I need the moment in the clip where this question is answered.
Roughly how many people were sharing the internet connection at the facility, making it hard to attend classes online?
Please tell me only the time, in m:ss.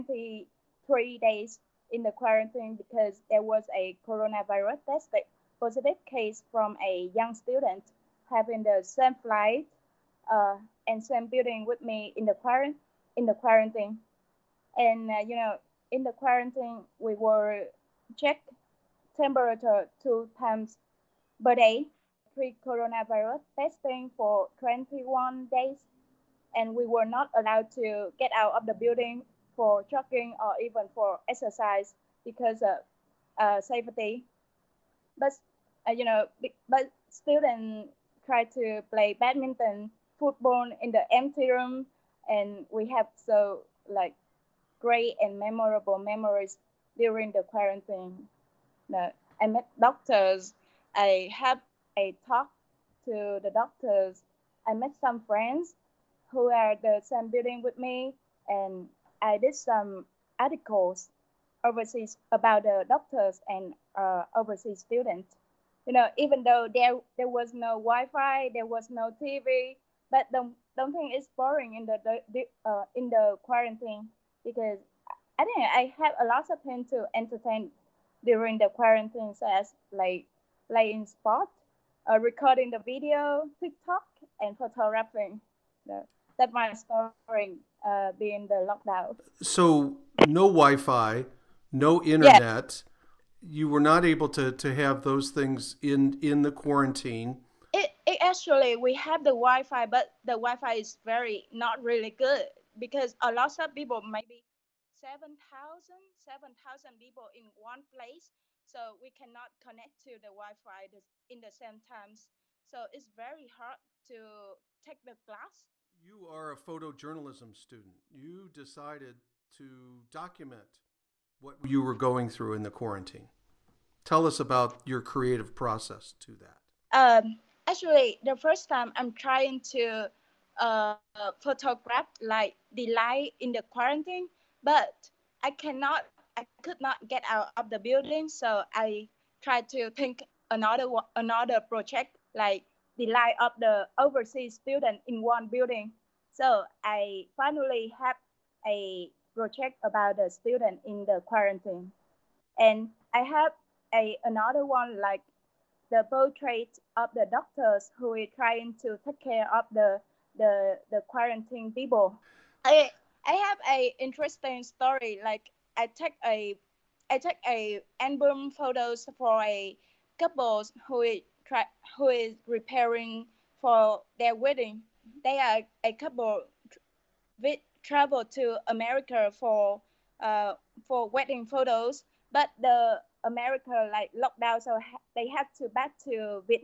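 1:44.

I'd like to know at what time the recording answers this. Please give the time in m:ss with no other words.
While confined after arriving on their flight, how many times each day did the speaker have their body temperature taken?
0:20.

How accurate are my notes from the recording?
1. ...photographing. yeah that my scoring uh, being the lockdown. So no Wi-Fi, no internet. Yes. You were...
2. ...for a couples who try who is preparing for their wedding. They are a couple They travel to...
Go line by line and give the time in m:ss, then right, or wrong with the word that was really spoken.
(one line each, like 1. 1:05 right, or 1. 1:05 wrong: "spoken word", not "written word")
1. 1:24 right
2. 2:49 right.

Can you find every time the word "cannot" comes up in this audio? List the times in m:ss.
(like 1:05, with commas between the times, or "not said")
1:49, 2:15.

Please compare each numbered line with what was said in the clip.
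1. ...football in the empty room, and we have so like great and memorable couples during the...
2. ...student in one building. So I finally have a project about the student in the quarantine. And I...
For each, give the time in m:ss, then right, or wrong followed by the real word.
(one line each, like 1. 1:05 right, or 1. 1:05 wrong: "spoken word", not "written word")
1. 0:40 wrong: "memories", not "couples"
2. 2:24 right.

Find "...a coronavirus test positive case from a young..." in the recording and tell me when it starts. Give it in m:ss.
0:03.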